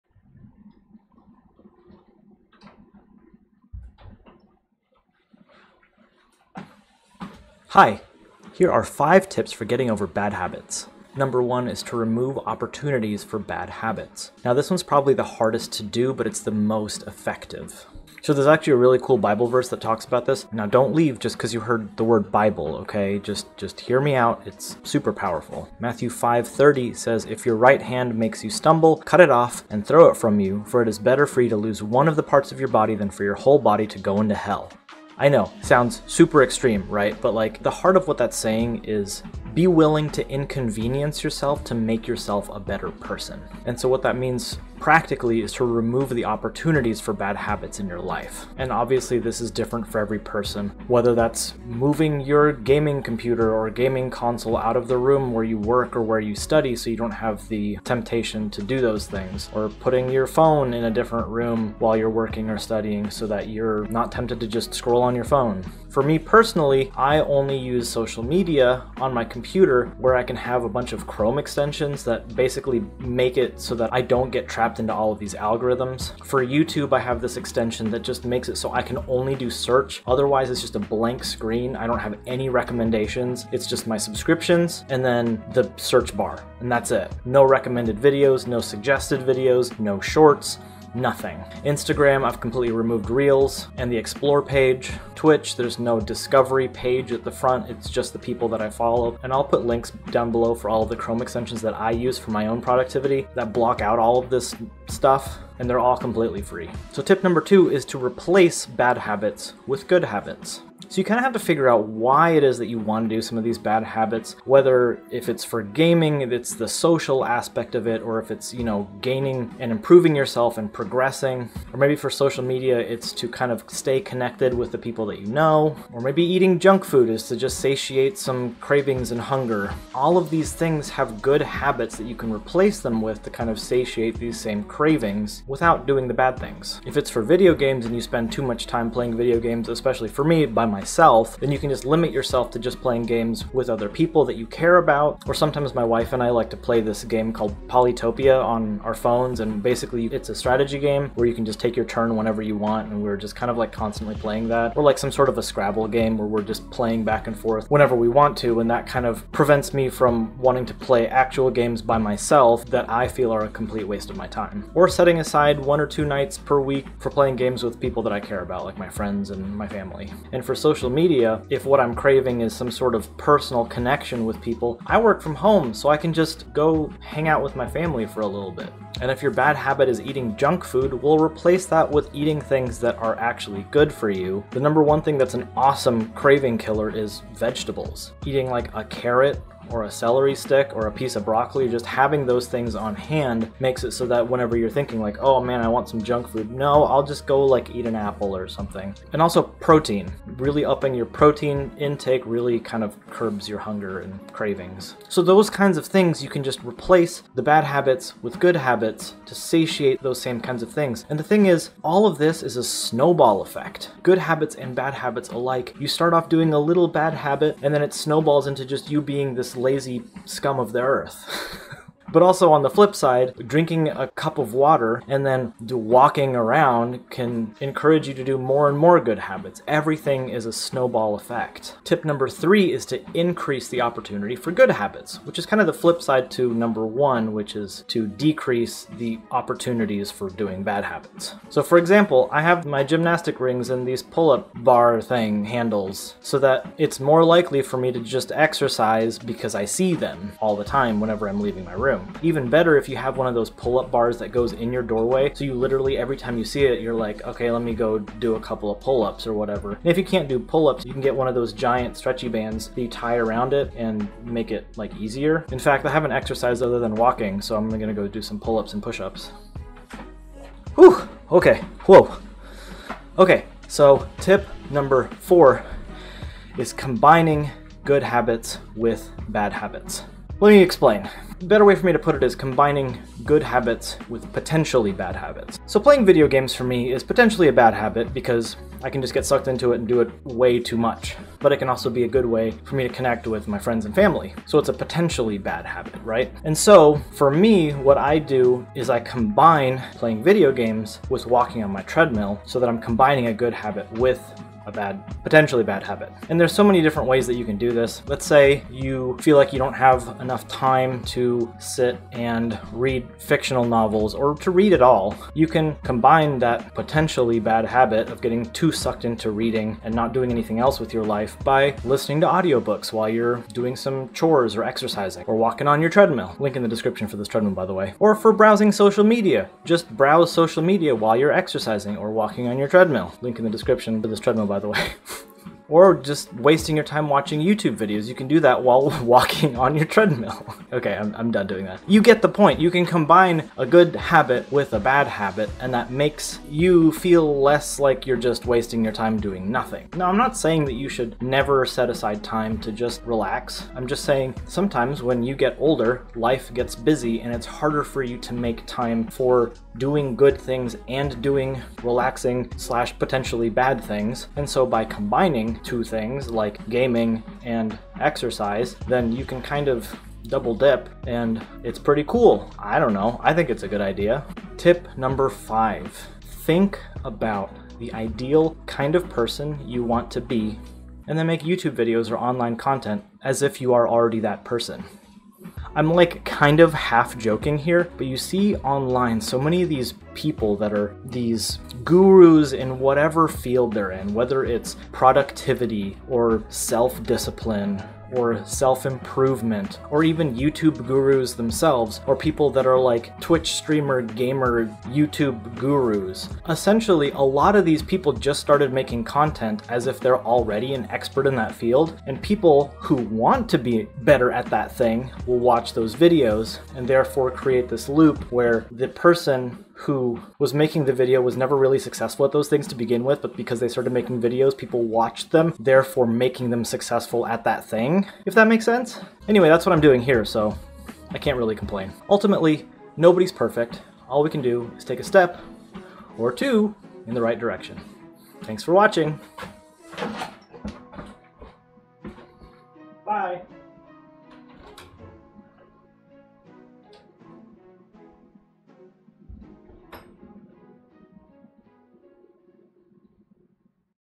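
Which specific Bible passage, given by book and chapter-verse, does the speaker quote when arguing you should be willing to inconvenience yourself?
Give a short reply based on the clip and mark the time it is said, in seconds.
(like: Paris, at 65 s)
Matthew 5:30, at 25 s.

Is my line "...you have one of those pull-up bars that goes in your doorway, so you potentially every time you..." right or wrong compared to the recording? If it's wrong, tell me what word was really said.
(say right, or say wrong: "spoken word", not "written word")
wrong: "literally", not "potentially".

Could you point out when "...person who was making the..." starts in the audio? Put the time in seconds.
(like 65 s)
418 s.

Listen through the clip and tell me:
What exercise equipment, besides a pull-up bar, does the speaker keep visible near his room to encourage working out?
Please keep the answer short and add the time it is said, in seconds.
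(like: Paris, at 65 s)
gymnastic rings, at 242 s.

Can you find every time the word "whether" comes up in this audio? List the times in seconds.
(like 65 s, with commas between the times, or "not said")
50 s, 114 s, 394 s.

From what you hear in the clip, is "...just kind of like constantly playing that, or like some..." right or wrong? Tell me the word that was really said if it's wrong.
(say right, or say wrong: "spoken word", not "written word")
right.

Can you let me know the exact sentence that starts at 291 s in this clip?
But it can also be a good way for me to connect with my friends and family.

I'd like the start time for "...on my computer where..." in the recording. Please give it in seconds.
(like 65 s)
68 s.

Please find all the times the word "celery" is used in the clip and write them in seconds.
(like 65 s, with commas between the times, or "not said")
189 s.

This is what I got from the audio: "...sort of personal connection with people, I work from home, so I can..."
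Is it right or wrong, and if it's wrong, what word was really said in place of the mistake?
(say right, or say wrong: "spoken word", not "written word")
right.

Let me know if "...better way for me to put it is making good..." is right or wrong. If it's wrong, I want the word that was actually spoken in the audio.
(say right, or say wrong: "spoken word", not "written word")
wrong: "combining", not "making".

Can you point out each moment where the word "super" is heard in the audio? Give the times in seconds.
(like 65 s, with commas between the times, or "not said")
24 s, 36 s.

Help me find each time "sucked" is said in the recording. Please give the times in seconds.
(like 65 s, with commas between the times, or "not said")
289 s, 318 s.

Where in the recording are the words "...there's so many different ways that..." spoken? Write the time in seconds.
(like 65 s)
306 s.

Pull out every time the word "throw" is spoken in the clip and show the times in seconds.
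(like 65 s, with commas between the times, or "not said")
29 s.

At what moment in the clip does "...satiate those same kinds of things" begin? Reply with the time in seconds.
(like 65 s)
209 s.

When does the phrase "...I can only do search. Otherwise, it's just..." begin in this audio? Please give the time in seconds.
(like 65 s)
78 s.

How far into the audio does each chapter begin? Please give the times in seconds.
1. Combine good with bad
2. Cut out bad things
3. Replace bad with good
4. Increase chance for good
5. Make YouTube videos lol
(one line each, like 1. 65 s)
1. 274 s
2. 10 s
3. 107 s
4. 231 s
5. 374 s.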